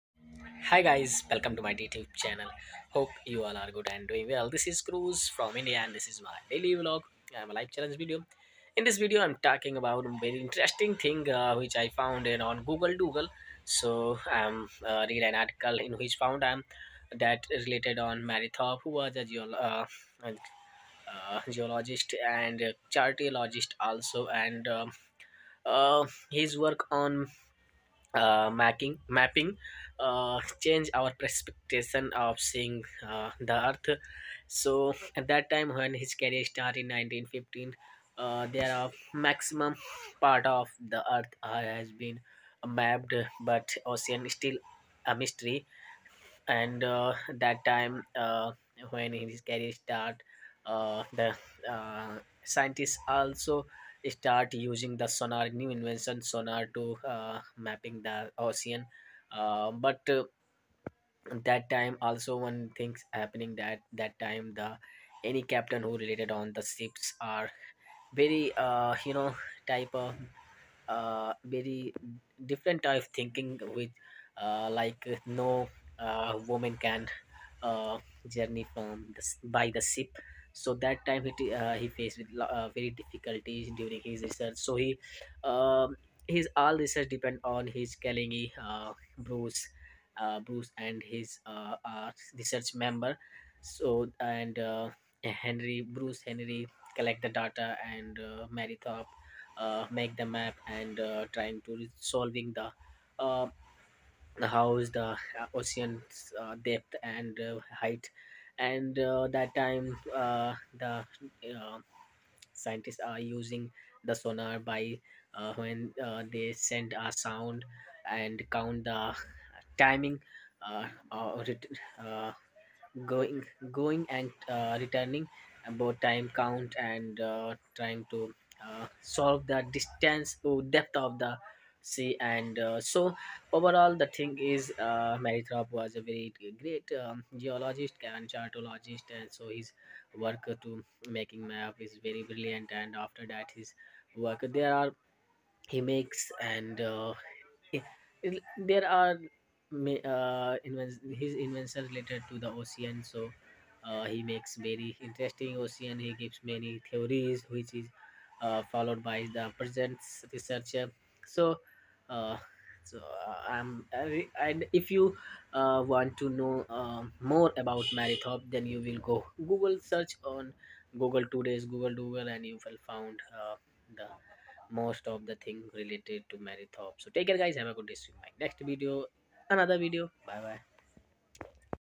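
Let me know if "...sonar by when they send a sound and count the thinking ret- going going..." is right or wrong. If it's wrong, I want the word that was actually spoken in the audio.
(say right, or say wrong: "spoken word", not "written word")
wrong: "timing", not "thinking".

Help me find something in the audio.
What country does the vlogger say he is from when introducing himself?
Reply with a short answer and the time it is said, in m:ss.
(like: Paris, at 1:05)
India, at 0:05.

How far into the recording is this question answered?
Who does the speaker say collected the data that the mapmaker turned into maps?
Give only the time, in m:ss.
1:35.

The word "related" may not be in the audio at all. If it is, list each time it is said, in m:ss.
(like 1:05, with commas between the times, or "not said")
0:17, 1:05, 2:31, 2:55.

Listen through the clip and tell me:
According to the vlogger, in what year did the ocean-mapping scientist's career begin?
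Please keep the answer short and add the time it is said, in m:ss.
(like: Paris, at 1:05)
1915, at 0:36.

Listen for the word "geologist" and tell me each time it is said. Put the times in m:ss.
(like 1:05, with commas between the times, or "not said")
0:21, 2:17.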